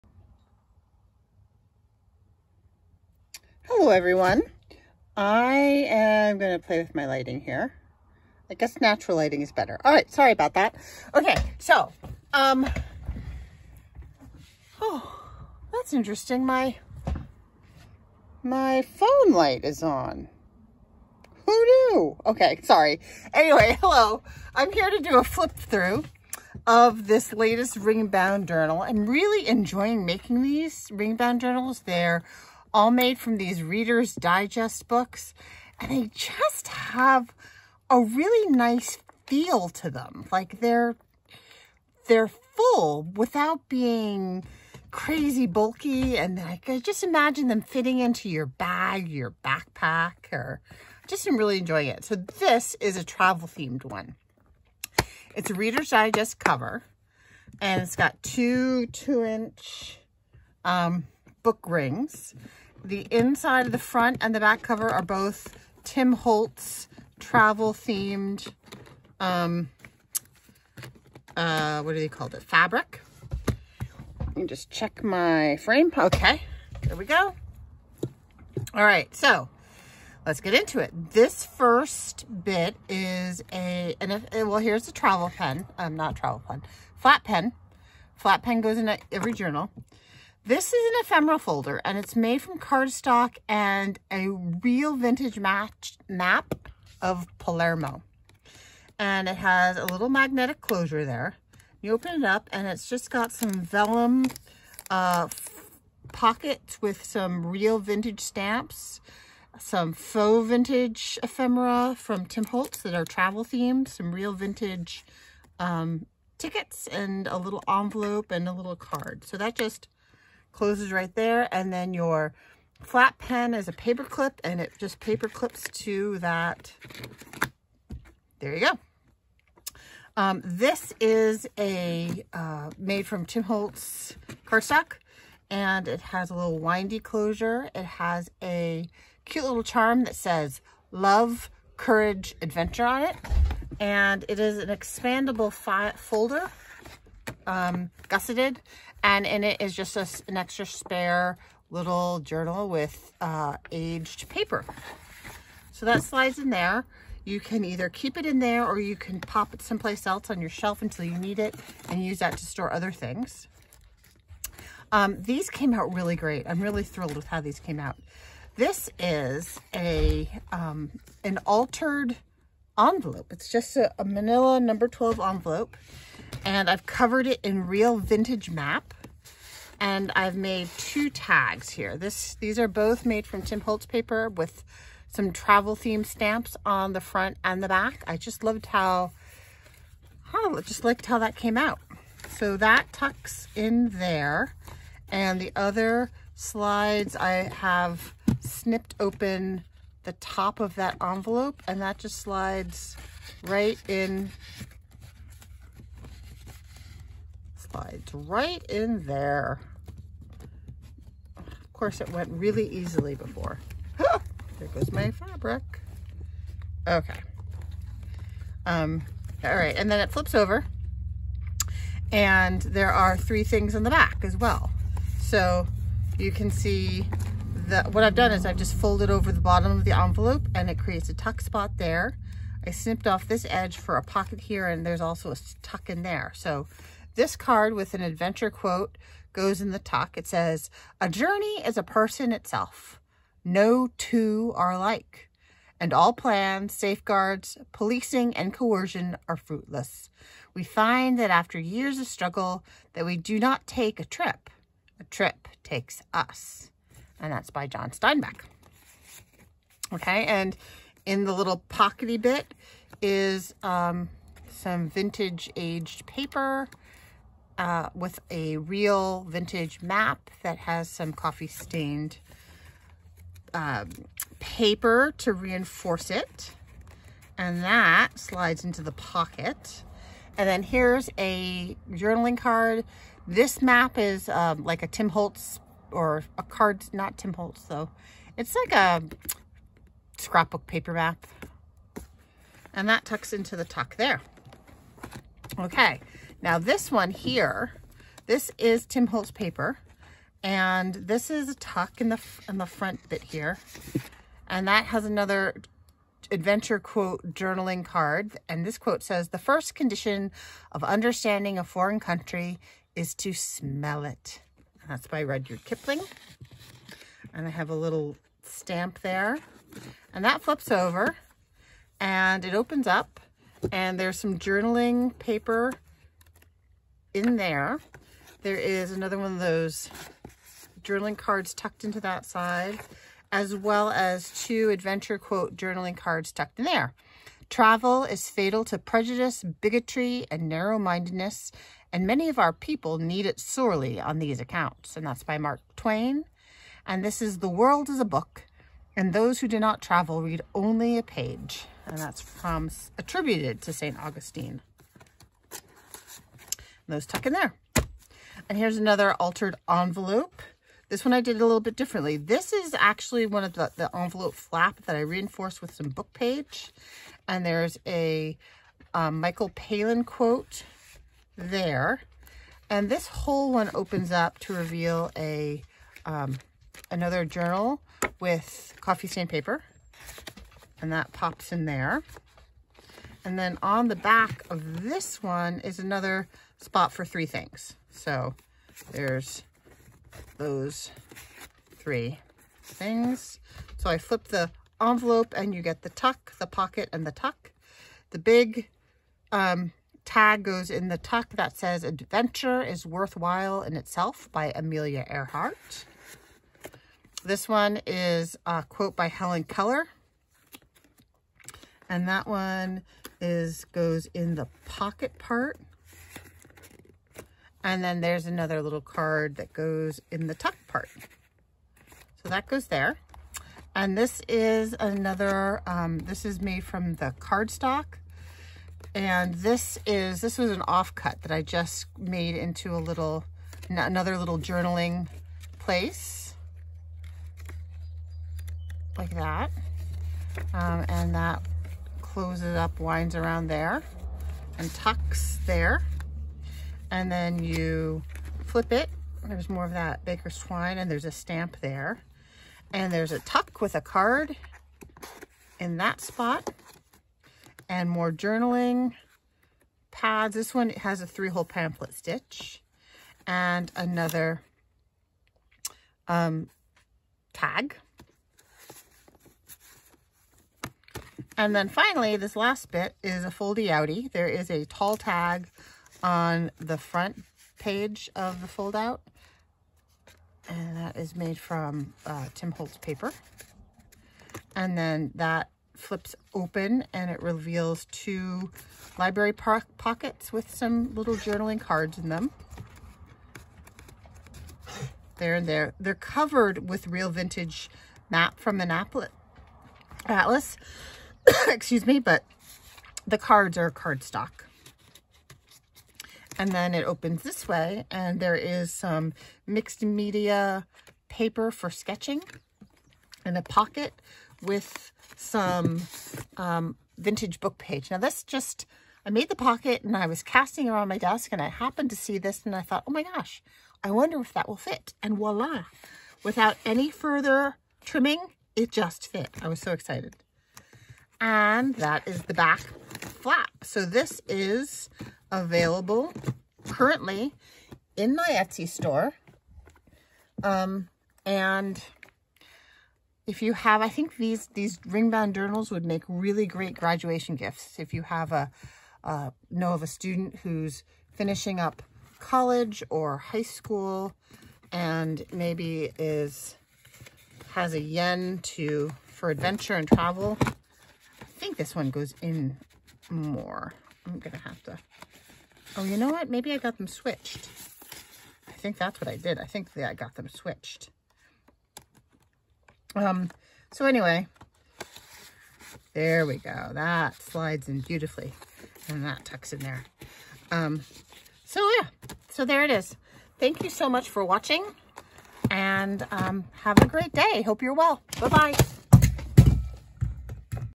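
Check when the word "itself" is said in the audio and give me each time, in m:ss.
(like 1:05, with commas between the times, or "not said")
4:02, 6:43.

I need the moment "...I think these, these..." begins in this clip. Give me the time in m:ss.
9:03.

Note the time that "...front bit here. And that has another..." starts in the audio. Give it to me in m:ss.
5:02.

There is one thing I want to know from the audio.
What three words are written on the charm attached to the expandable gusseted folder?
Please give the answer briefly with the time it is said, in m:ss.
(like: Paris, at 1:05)
love, courage, adventure, at 2:20.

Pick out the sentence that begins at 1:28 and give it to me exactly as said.
Flat pen goes in every journal.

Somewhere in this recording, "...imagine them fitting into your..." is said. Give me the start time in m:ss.
0:47.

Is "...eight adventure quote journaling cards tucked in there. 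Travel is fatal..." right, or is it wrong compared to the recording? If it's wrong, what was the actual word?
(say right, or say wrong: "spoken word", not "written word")
wrong: "two", not "eight".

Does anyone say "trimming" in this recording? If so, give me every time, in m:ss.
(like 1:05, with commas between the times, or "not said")
8:47.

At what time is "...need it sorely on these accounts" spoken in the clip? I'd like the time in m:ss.
5:42.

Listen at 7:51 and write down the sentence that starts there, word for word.
And then finally, this last bit is a foldy outie.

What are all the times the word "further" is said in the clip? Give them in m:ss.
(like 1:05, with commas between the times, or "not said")
8:46.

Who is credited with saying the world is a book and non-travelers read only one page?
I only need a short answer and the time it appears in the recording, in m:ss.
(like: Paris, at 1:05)
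St. Augustine, at 5:53.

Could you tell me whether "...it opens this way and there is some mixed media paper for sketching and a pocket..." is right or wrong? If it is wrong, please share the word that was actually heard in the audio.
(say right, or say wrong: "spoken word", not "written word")
right.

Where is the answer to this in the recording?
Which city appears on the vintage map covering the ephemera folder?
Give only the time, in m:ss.
1:37.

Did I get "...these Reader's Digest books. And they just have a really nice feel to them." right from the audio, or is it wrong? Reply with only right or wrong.
right.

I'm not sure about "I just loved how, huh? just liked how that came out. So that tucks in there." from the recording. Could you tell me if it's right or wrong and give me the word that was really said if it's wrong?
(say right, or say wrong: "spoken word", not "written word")
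right.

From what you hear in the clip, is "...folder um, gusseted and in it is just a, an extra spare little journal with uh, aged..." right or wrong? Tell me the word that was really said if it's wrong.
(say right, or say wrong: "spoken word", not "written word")
right.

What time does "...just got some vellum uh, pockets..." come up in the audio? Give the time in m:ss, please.
1:42.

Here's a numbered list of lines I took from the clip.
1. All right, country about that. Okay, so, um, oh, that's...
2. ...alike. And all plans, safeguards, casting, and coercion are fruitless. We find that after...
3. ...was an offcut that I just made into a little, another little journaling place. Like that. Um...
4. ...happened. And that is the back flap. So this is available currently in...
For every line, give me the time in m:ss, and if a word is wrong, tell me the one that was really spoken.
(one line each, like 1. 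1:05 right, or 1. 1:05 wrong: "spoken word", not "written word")
1. 0:09 wrong: "sorry", not "country"
2. 4:04 wrong: "policing", not "casting"
3. 7:10 right
4. 8:49 wrong: "excited", not "happened".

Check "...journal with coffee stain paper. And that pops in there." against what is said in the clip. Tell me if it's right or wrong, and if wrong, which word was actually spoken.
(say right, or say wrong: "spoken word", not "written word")
right.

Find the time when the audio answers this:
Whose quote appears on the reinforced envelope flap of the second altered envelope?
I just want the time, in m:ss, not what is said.
6:09.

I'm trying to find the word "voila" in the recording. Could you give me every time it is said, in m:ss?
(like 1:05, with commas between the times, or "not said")
8:45.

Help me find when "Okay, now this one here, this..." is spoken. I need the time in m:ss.
4:55.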